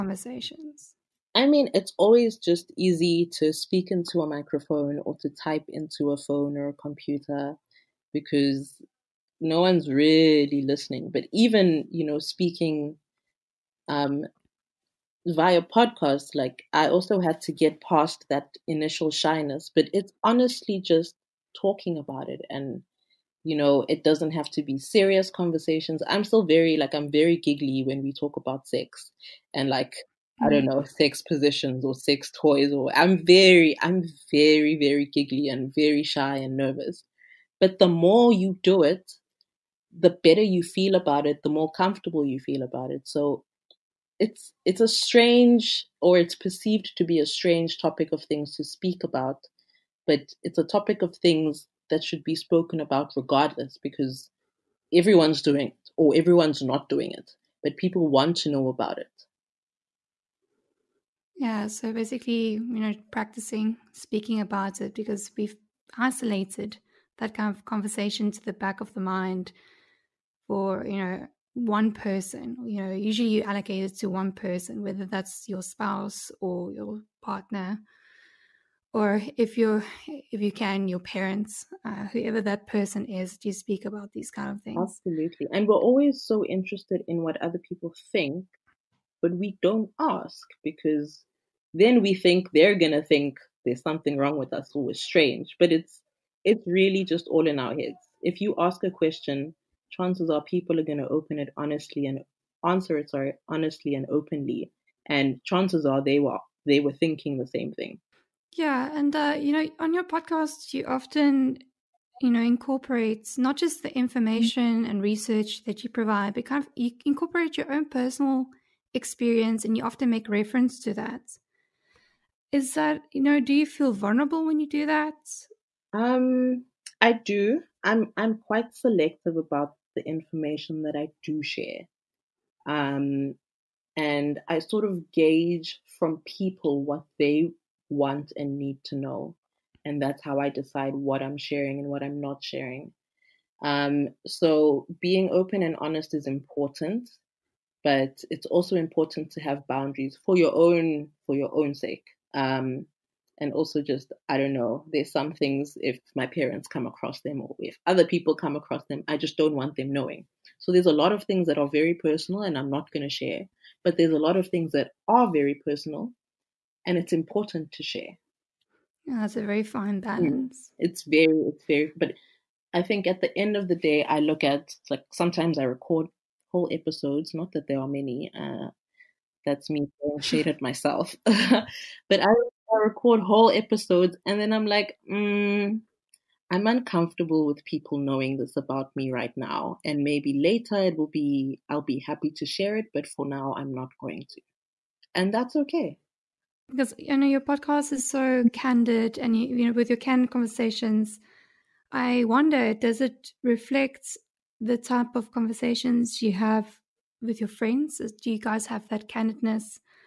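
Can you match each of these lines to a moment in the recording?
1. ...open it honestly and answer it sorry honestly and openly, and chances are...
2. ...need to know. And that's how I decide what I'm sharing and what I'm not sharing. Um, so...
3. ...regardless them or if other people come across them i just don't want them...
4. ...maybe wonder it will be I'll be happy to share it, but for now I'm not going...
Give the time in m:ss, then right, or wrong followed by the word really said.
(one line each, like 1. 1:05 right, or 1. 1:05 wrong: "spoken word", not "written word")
1. 1:41 right
2. 2:18 right
3. 2:36 wrong: "across", not "regardless"
4. 3:10 wrong: "later", not "wonder".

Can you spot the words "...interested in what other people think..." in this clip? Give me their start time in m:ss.
1:26.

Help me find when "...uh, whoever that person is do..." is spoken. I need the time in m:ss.
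1:21.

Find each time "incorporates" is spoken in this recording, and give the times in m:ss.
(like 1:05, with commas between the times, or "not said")
1:52, 1:57.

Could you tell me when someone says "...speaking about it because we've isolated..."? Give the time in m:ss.
1:03.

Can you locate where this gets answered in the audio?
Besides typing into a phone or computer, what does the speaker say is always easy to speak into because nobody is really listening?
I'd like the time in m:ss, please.
0:04.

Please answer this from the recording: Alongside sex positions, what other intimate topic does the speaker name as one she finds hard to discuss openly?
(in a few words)
sex toys.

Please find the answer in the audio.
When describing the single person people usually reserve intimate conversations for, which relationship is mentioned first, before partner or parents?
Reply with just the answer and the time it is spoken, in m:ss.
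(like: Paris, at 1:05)
spouse, at 1:15.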